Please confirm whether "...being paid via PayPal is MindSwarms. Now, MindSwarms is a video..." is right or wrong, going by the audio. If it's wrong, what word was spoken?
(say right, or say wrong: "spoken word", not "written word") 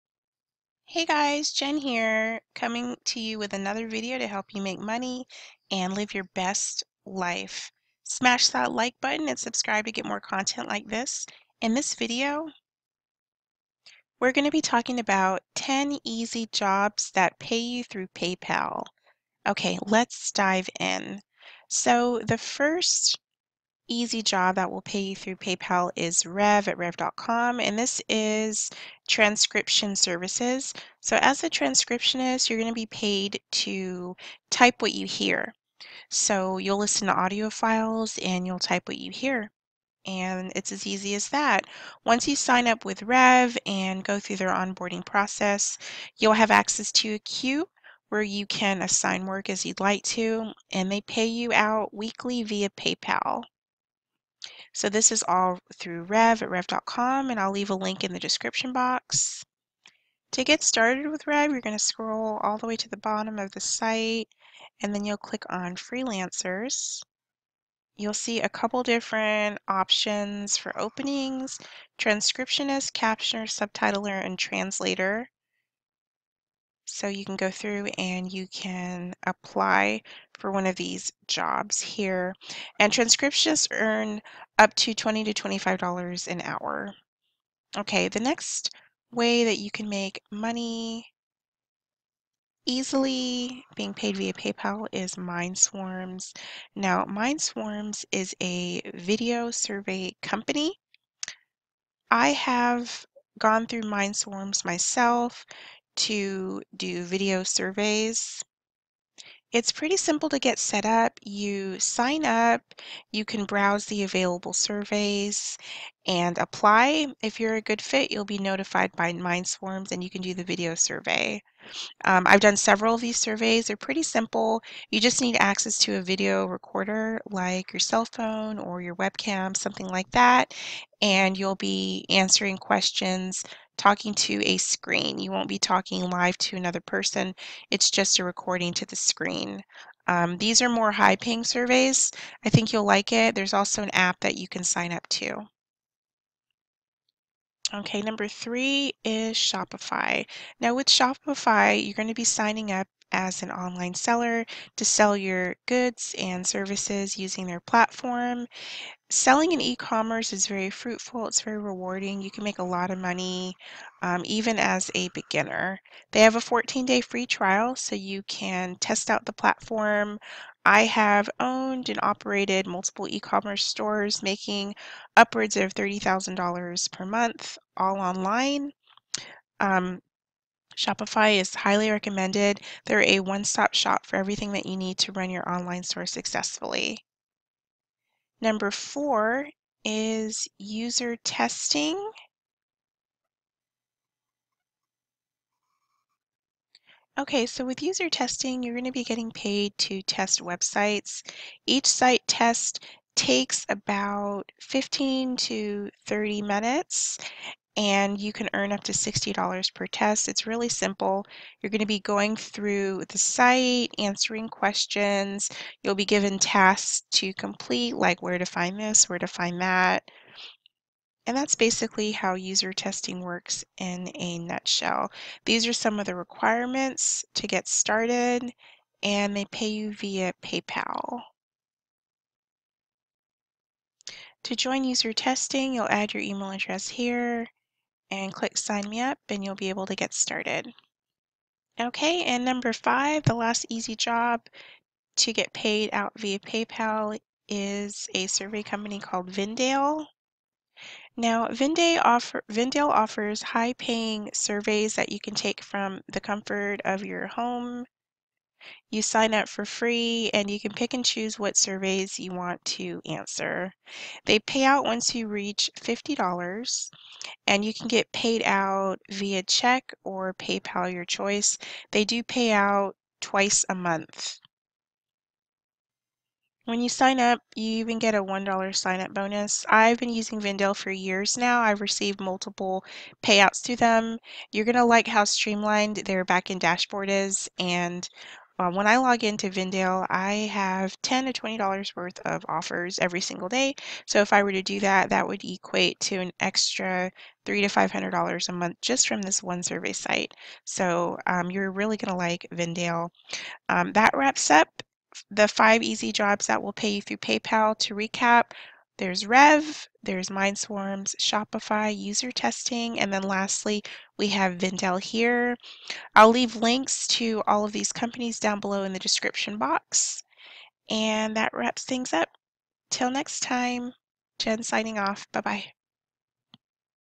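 right.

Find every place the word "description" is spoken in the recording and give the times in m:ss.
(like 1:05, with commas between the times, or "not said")
0:58, 5:18.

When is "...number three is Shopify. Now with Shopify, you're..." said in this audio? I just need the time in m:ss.
2:28.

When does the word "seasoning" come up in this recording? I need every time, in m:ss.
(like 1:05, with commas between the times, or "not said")
not said.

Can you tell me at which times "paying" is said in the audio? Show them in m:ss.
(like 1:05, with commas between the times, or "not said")
2:21, 4:13.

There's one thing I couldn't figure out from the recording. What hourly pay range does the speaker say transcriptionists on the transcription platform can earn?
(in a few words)
$20 to $25 an hour.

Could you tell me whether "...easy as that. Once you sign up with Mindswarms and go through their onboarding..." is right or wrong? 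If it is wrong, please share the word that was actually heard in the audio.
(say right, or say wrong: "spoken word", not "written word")
wrong: "Rev", not "Mindswarms".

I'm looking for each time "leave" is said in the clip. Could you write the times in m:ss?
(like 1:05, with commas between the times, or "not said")
0:57, 5:16.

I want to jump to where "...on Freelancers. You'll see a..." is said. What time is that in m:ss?
1:05.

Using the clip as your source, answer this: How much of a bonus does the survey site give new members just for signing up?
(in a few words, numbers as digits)
$1.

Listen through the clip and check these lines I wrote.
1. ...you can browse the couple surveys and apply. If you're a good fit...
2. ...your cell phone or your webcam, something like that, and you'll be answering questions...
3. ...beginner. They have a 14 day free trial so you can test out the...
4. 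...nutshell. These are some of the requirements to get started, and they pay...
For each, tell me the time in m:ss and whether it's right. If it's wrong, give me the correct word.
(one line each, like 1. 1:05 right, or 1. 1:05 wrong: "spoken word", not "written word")
1. 1:53 wrong: "available", not "couple"
2. 2:07 right
3. 2:45 right
4. 3:44 right.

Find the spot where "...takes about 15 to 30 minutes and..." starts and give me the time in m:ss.
3:23.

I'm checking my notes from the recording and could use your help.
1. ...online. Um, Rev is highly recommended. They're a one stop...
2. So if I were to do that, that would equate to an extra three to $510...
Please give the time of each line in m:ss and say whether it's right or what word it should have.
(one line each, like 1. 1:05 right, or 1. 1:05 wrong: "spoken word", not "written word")
1. 2:57 wrong: "Shopify", not "Rev"
2. 4:54 wrong: "500", not "510".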